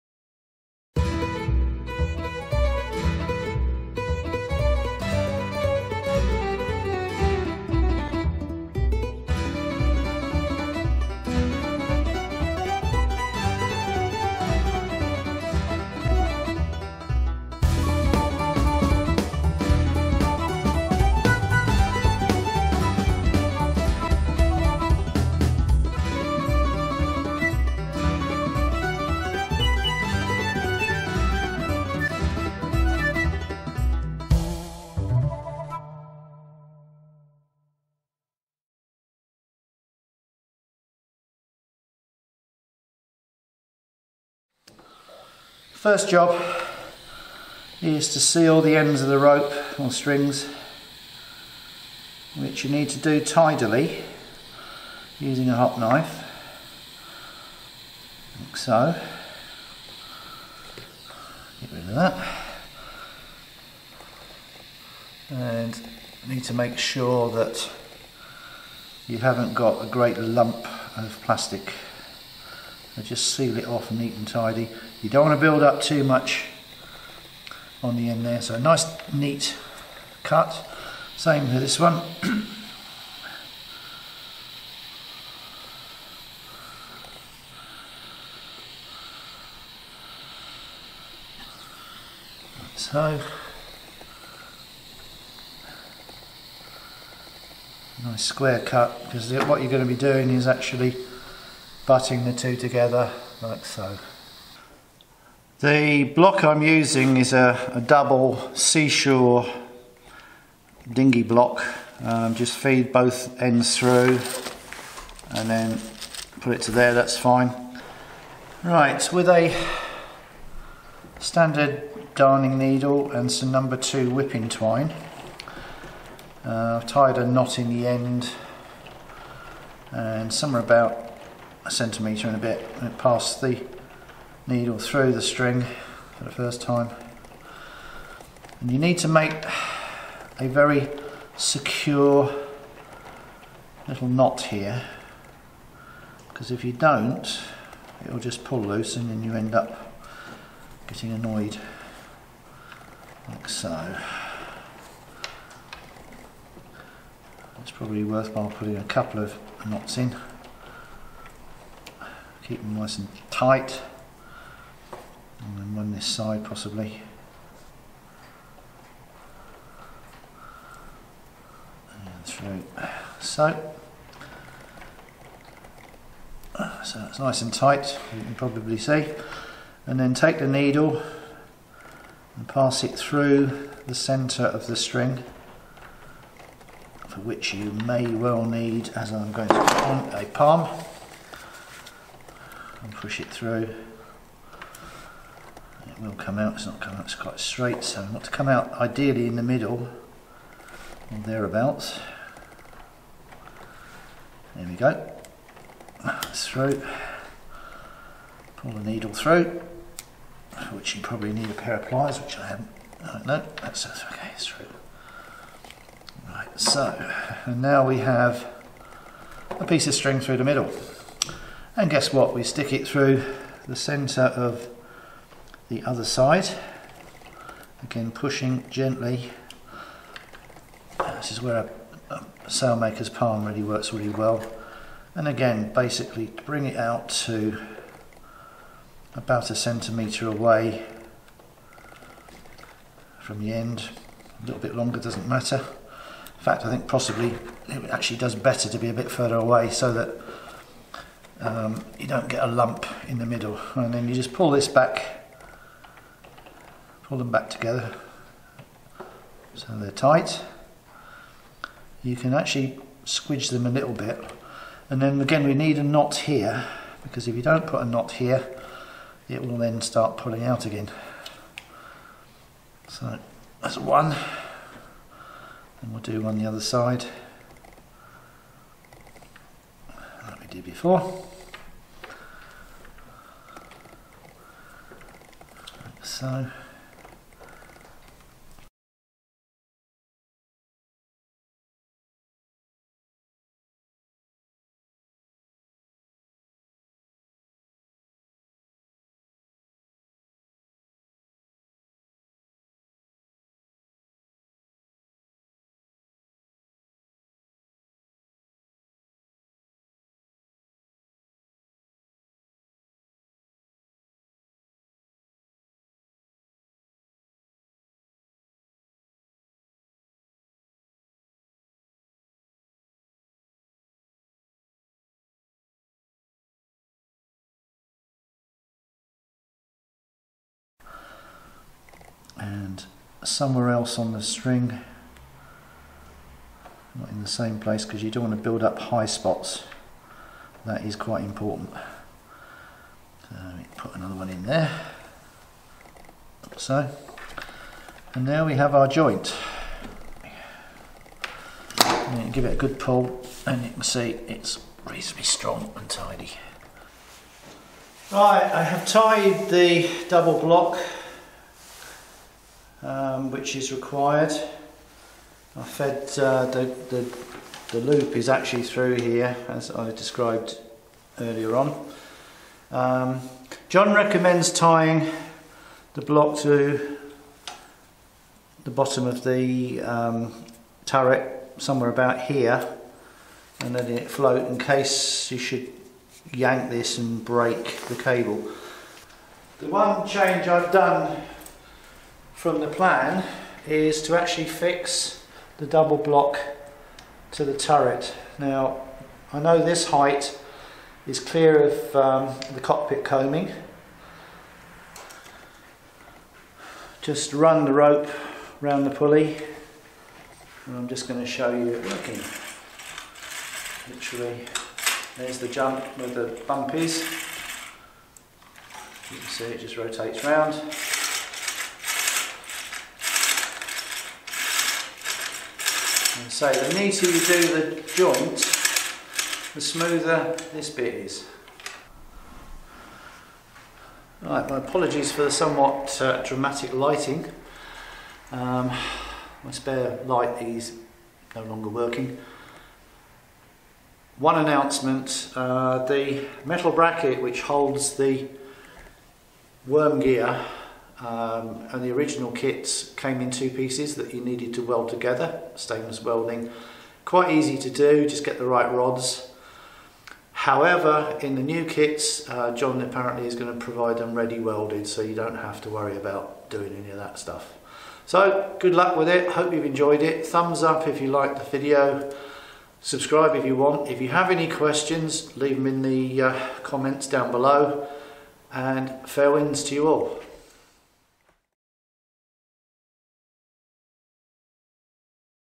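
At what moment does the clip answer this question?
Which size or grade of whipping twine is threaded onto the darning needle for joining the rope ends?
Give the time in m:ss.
2:03.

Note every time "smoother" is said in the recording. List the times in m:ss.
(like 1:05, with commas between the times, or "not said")
7:09.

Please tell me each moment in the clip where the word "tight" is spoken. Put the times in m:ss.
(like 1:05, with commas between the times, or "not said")
2:43, 2:57, 4:19.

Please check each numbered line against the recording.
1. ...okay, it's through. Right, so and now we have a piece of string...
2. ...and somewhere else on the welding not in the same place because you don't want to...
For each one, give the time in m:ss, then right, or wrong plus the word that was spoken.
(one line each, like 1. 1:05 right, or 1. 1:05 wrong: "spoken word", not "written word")
1. 3:33 right
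2. 5:32 wrong: "string", not "welding".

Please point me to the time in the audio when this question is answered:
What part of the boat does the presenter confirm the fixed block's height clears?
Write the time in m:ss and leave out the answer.
6:42.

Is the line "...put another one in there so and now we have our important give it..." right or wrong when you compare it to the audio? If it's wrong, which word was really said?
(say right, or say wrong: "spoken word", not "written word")
wrong: "joint", not "important".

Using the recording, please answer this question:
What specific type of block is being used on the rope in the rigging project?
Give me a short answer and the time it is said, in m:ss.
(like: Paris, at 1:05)
double Seasure dinghy block, at 1:47.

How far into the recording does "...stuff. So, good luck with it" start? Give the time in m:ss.
7:47.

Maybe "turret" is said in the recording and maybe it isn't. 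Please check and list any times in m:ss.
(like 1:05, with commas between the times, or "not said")
6:20, 6:37.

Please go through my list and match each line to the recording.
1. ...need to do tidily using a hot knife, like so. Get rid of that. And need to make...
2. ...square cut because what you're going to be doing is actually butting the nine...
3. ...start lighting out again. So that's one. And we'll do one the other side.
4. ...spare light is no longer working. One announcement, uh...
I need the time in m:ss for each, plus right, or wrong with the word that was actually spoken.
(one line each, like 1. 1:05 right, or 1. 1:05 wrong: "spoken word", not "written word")
1. 0:52 right
2. 1:38 wrong: "two", not "nine"
3. 4:29 wrong: "pulling", not "lighting"
4. 7:19 right.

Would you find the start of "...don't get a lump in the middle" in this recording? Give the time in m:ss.
4:12.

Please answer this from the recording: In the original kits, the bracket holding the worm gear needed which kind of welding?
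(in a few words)
stainless welding.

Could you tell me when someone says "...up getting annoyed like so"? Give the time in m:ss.
2:29.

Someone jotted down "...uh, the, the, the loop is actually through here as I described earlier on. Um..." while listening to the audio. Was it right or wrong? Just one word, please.
right.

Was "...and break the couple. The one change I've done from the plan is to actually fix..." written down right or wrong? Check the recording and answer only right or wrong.
wrong.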